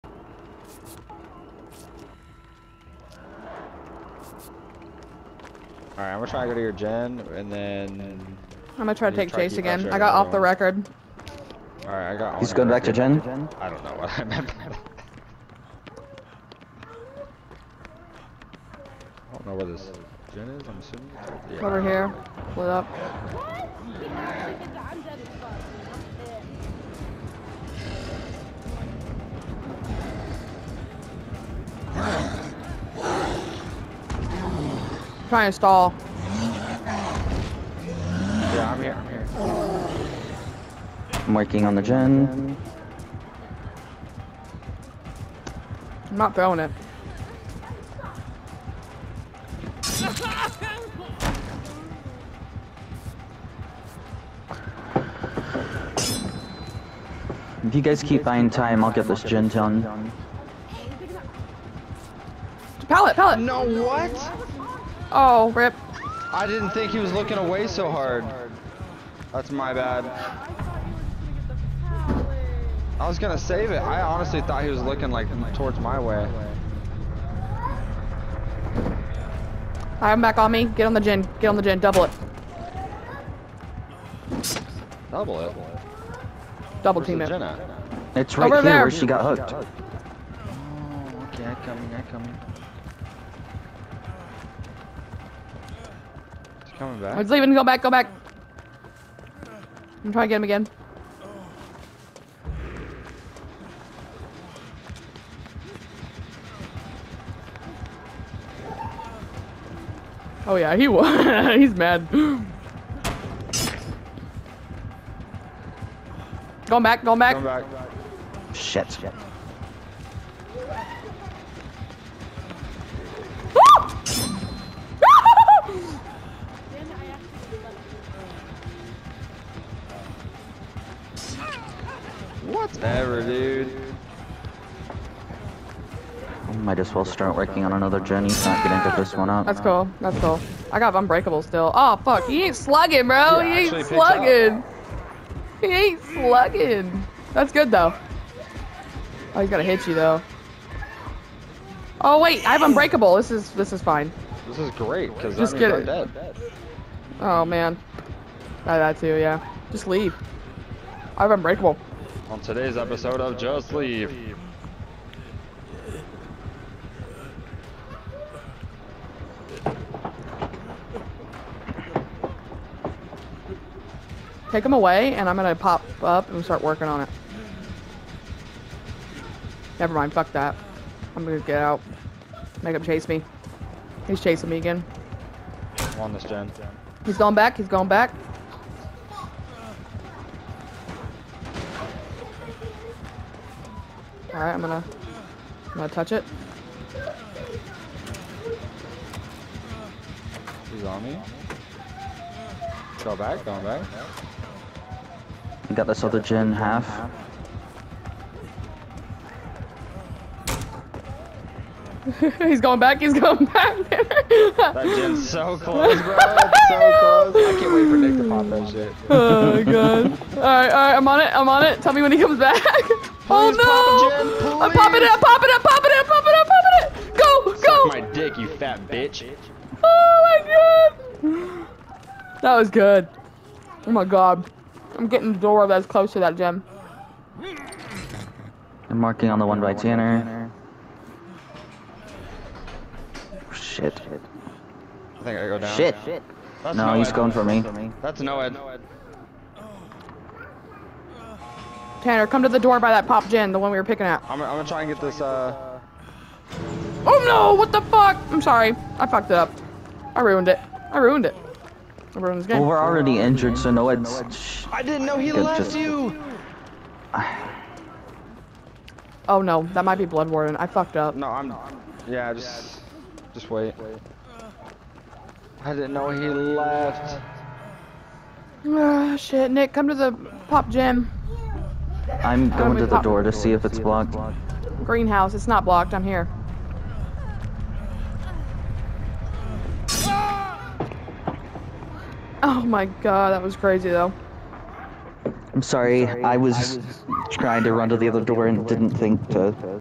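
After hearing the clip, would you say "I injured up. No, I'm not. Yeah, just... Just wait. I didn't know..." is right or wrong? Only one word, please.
wrong.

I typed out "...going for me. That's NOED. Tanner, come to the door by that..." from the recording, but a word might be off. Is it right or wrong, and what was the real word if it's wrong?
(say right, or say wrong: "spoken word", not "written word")
right.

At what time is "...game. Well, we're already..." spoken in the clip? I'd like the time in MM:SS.
04:22.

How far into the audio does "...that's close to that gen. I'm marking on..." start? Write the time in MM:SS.
03:55.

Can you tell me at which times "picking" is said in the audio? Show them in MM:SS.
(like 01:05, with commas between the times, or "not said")
04:13.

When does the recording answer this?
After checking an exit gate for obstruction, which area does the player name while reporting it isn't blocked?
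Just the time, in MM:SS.
04:44.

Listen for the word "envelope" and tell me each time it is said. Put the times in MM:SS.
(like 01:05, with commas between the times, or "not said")
not said.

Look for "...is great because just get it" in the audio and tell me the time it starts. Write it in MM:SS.
02:34.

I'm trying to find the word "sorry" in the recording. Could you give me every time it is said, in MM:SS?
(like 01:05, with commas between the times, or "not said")
04:18, 04:55.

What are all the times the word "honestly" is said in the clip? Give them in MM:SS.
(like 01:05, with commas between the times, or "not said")
01:14.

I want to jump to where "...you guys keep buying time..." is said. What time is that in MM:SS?
00:57.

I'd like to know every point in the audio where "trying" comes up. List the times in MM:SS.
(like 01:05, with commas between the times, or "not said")
00:35, 01:40, 04:57.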